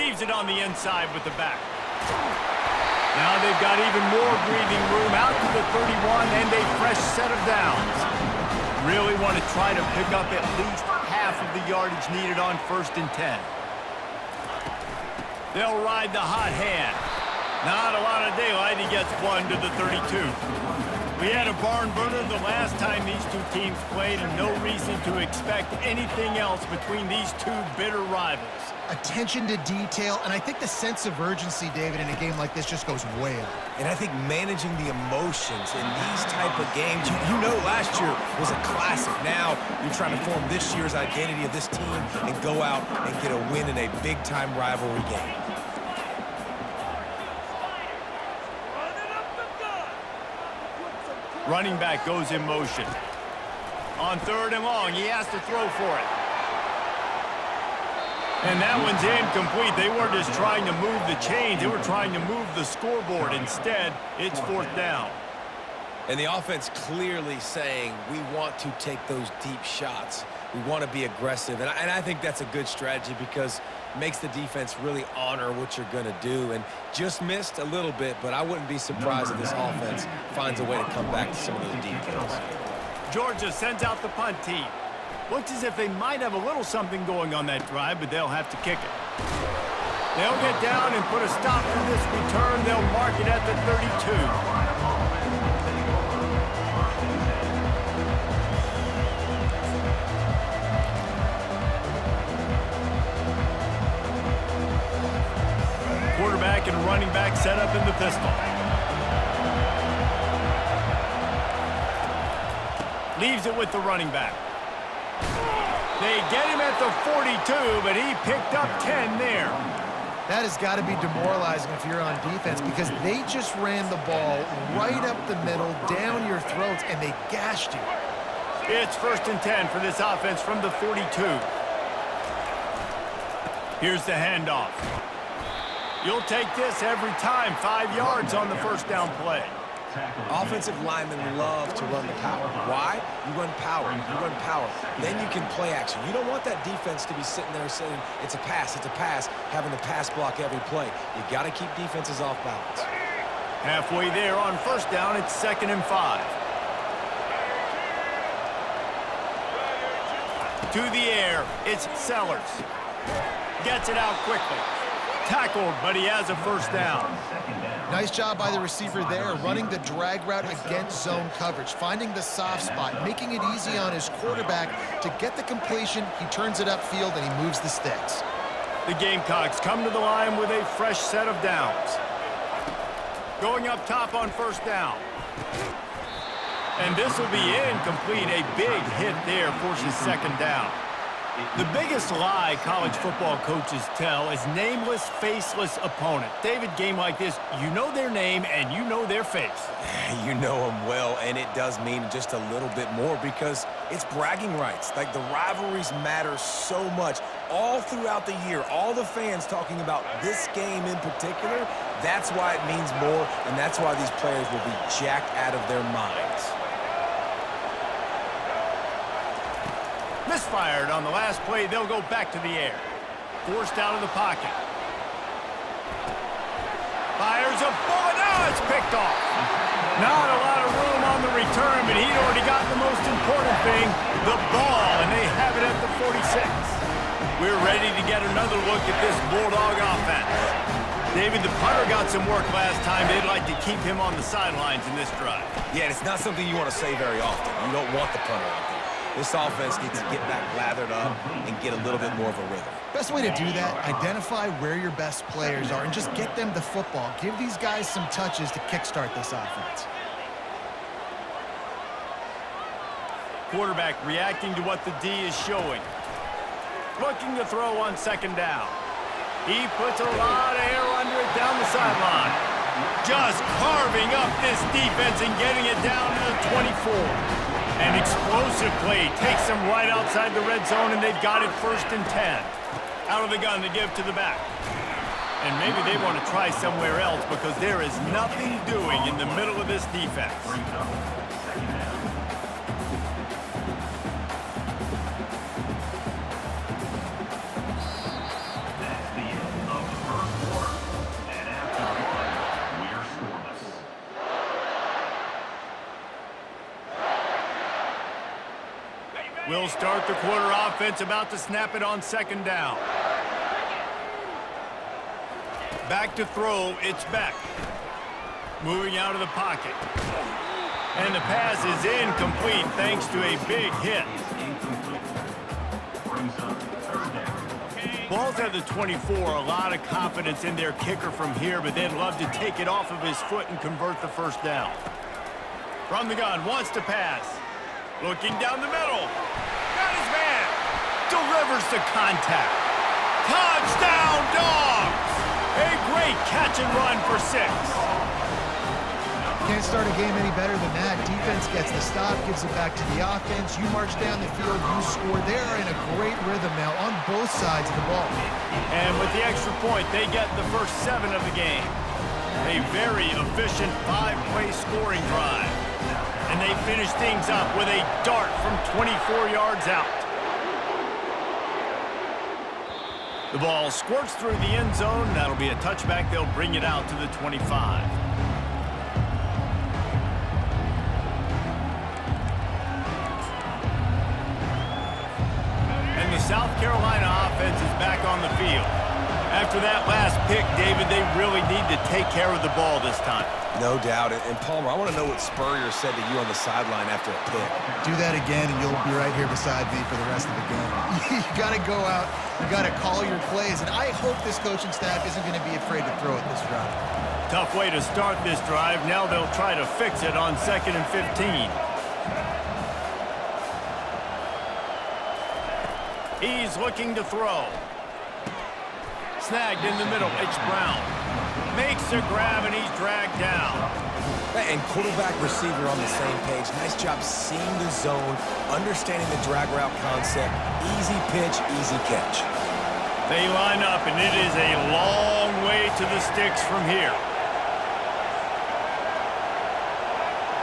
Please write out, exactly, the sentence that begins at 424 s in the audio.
And quarterback receiver on the same page.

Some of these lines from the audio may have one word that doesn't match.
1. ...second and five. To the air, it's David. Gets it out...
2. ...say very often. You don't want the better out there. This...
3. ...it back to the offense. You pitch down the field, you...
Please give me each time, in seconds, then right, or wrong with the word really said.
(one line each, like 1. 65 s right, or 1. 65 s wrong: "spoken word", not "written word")
1. 155 s wrong: "Sellers", not "David"
2. 246 s wrong: "punter", not "better"
3. 352 s wrong: "march", not "pitch".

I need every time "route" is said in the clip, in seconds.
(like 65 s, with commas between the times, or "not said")
170 s, 429 s.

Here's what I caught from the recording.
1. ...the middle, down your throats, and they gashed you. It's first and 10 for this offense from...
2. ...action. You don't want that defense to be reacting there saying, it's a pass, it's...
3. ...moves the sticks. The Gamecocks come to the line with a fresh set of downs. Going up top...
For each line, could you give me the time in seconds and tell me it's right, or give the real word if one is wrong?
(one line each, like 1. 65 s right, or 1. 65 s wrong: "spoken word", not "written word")
1. 125 s right
2. 145 s wrong: "sitting", not "reacting"
3. 177 s right.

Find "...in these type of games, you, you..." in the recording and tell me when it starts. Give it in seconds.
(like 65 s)
35 s.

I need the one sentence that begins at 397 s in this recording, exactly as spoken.
Do that again, and you'll be right here beside me for the rest of the game.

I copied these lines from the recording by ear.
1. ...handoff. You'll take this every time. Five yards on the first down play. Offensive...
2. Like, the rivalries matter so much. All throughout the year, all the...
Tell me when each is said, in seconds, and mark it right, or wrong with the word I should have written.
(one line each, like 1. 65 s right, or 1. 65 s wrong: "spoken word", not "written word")
1. 134 s right
2. 204 s right.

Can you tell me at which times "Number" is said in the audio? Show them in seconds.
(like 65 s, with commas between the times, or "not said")
79 s.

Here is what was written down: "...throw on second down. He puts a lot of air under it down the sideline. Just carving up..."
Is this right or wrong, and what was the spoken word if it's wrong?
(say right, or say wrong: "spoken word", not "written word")
right.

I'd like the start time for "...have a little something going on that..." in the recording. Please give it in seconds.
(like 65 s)
86 s.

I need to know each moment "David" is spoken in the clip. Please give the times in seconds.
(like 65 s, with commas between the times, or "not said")
31 s, 196 s, 241 s, 390 s.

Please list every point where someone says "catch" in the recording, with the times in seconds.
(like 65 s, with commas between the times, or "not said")
346 s, 431 s.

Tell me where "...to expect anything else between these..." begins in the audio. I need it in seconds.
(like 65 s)
25 s.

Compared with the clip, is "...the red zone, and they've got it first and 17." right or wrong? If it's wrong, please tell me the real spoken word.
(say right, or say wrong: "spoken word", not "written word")
wrong: "10", not "17".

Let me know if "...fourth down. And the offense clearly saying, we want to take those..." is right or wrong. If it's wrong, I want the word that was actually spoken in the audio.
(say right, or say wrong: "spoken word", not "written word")
right.